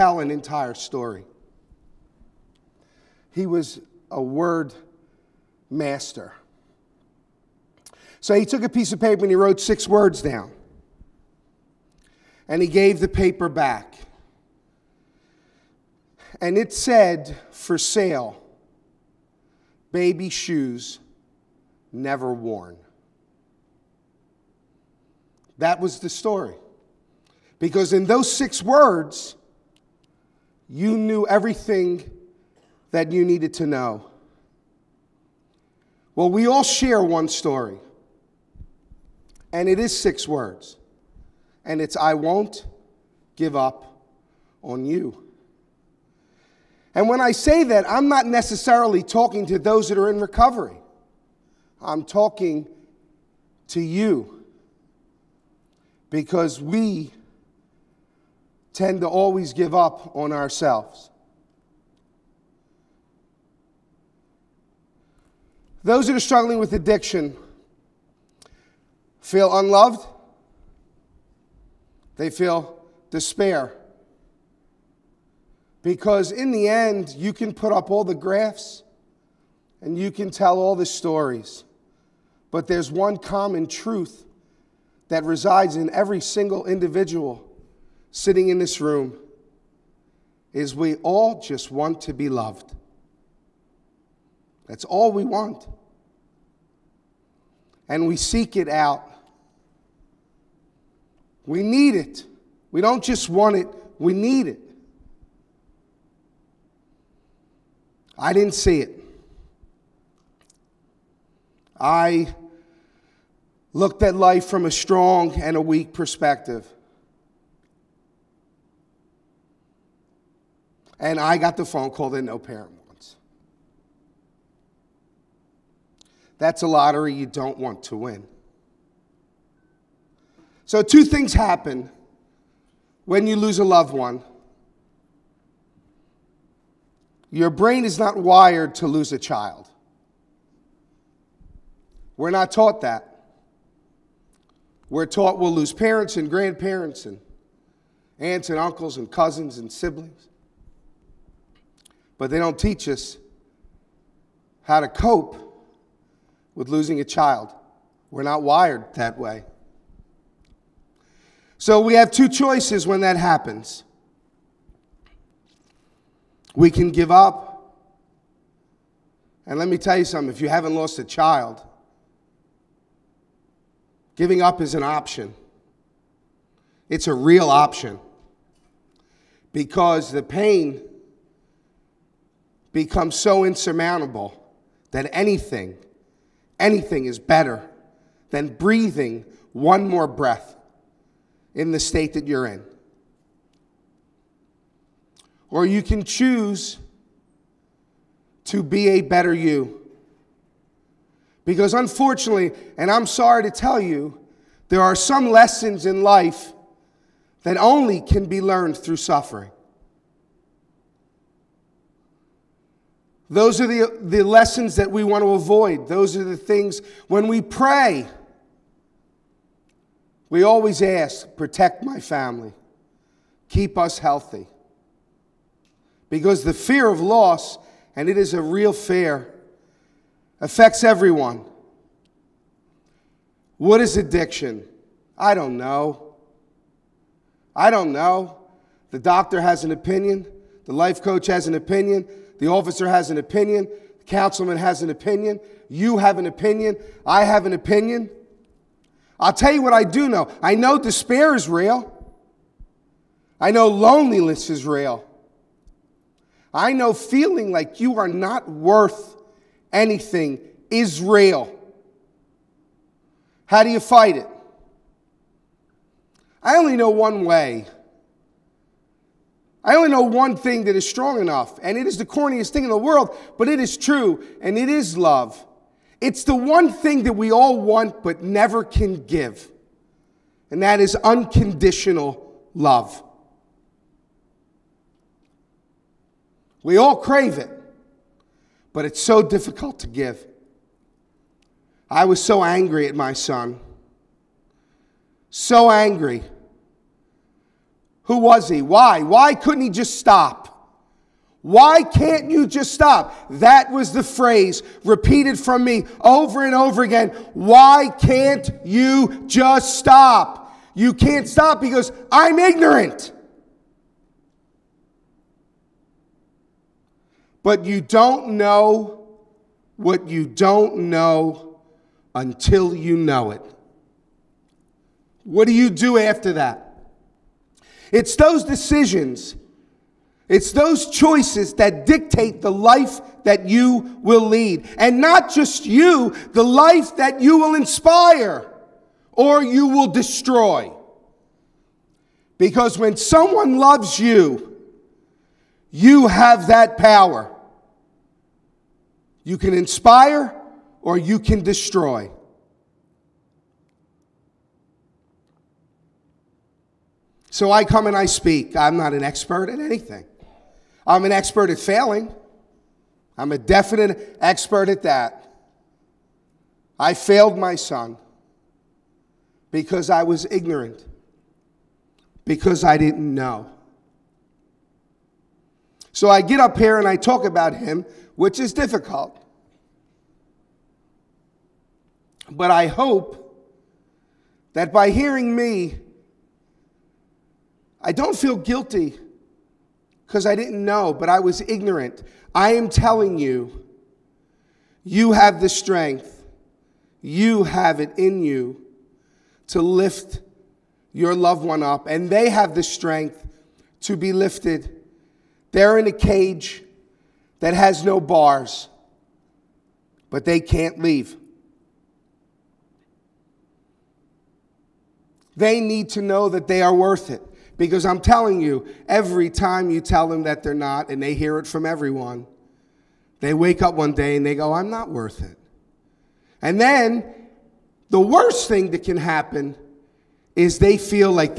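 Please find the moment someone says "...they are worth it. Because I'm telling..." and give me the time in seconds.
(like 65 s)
416 s.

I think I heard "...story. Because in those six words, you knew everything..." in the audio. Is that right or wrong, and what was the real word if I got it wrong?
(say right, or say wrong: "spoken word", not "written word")
right.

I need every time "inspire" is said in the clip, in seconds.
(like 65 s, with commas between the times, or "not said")
337 s, 349 s.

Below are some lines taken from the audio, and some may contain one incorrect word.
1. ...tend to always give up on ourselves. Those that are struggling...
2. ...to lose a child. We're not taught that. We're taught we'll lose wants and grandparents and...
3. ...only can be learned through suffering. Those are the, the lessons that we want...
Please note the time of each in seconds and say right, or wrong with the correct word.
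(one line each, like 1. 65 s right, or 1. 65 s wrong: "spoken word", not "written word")
1. 58 s right
2. 138 s wrong: "parents", not "wants"
3. 207 s right.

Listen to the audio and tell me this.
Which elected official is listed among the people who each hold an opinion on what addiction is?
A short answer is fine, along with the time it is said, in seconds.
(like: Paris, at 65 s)
the councilman, at 244 s.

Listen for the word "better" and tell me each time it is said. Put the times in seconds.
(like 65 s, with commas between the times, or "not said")
187 s, 199 s.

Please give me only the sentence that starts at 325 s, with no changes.
What do you do after that?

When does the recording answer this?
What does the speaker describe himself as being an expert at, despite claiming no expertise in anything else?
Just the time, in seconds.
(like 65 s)
361 s.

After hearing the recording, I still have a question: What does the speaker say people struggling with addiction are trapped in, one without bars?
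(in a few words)
a cage.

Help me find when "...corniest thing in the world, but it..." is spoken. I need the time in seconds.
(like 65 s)
272 s.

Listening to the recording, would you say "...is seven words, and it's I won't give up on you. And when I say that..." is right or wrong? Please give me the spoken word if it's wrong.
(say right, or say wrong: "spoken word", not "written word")
wrong: "six", not "seven".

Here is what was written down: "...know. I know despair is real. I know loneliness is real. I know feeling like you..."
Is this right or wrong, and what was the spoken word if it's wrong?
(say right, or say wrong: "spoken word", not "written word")
right.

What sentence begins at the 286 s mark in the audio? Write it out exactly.
We all crave it, but it's so difficult to give.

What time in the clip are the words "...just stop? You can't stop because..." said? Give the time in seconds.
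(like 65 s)
309 s.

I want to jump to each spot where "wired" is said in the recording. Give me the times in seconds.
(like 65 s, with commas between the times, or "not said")
138 s, 158 s.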